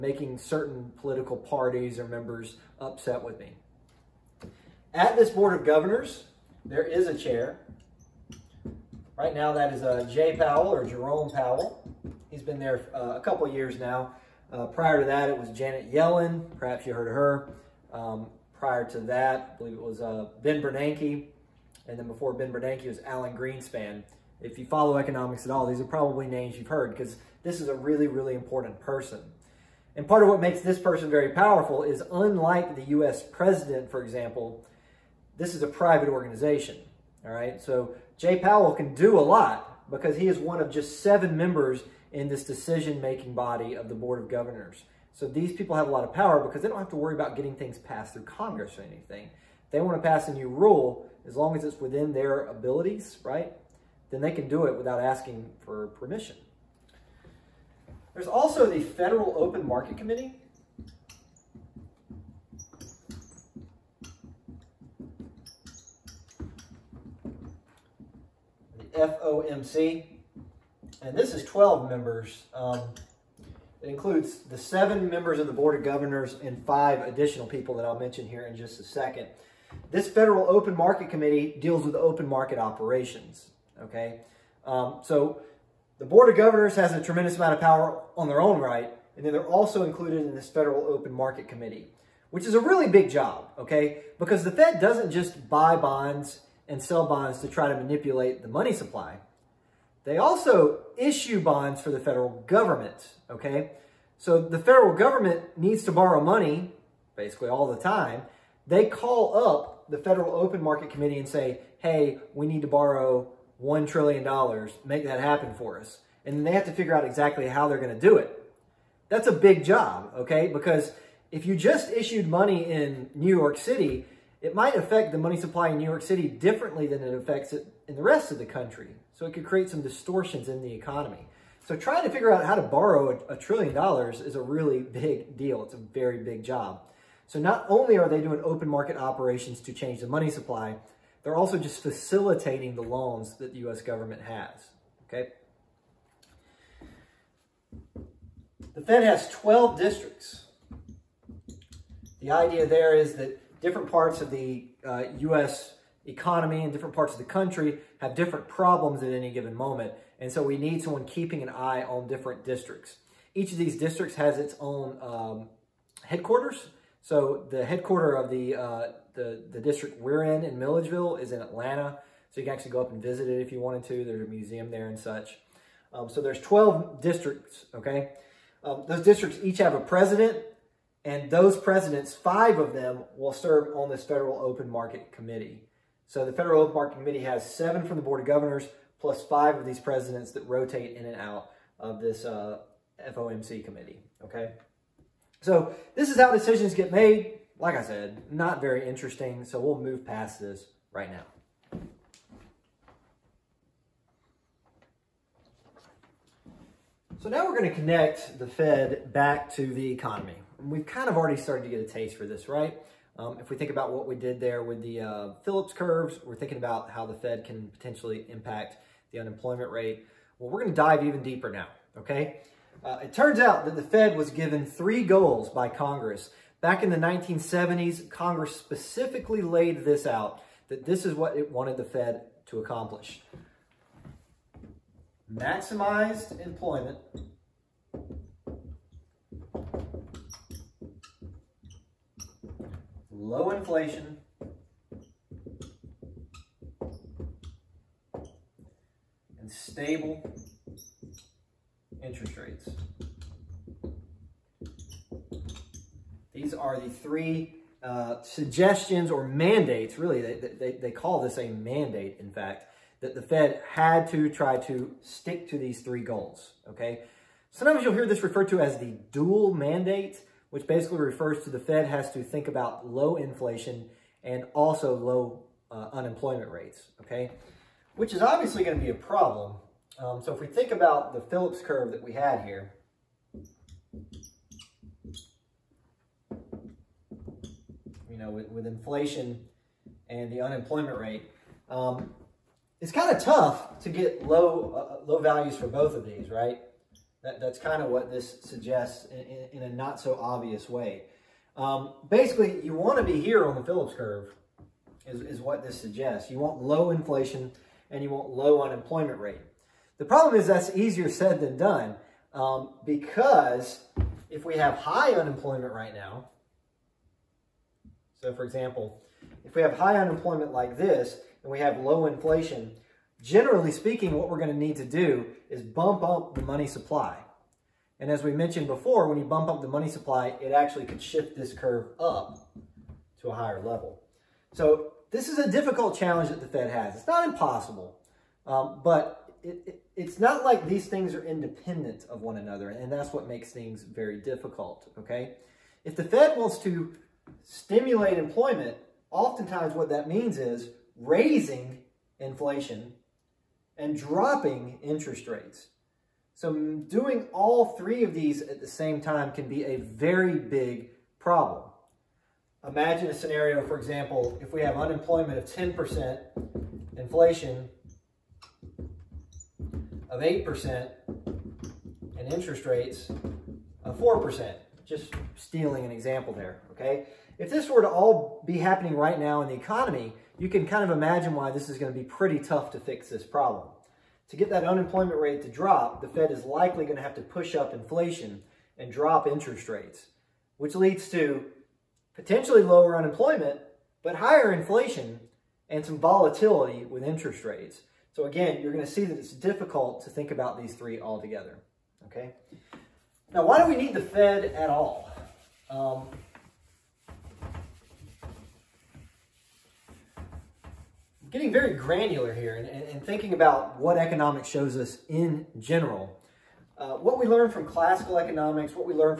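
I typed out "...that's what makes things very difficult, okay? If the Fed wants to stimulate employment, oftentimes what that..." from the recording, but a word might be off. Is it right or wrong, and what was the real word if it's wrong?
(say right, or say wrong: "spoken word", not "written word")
right.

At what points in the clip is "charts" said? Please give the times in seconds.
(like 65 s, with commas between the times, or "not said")
not said.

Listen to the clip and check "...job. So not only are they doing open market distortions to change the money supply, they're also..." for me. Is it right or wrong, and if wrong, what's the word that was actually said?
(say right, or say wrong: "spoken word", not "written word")
wrong: "operations", not "distortions".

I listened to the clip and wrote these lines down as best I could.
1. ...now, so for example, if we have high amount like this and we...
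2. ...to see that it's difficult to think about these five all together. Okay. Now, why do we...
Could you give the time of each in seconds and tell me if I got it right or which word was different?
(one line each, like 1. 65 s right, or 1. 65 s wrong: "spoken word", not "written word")
1. 315 s wrong: "unemployment", not "amount"
2. 398 s wrong: "three", not "five".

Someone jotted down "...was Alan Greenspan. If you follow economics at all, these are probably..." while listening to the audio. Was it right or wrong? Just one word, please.
right.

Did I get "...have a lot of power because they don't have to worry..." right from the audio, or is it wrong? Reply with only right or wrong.
right.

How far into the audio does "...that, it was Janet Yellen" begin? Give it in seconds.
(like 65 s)
15 s.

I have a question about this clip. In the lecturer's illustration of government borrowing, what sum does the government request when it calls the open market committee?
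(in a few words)
$1 trillion.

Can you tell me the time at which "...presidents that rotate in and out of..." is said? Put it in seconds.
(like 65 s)
189 s.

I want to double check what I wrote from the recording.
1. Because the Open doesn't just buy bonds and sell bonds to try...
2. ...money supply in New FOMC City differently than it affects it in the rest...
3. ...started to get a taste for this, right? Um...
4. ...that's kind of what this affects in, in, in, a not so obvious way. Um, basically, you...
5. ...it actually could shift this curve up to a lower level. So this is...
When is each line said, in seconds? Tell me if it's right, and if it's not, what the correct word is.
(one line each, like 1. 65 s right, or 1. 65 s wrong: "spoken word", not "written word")
1. 94 s wrong: "Fed", not "Open"
2. 125 s wrong: "York", not "FOMC"
3. 211 s right
4. 297 s wrong: "suggests", not "affects"
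5. 330 s wrong: "higher", not "lower".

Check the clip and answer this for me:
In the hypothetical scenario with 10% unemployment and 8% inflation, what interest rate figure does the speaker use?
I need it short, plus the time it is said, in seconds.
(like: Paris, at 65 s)
4%, at 373 s.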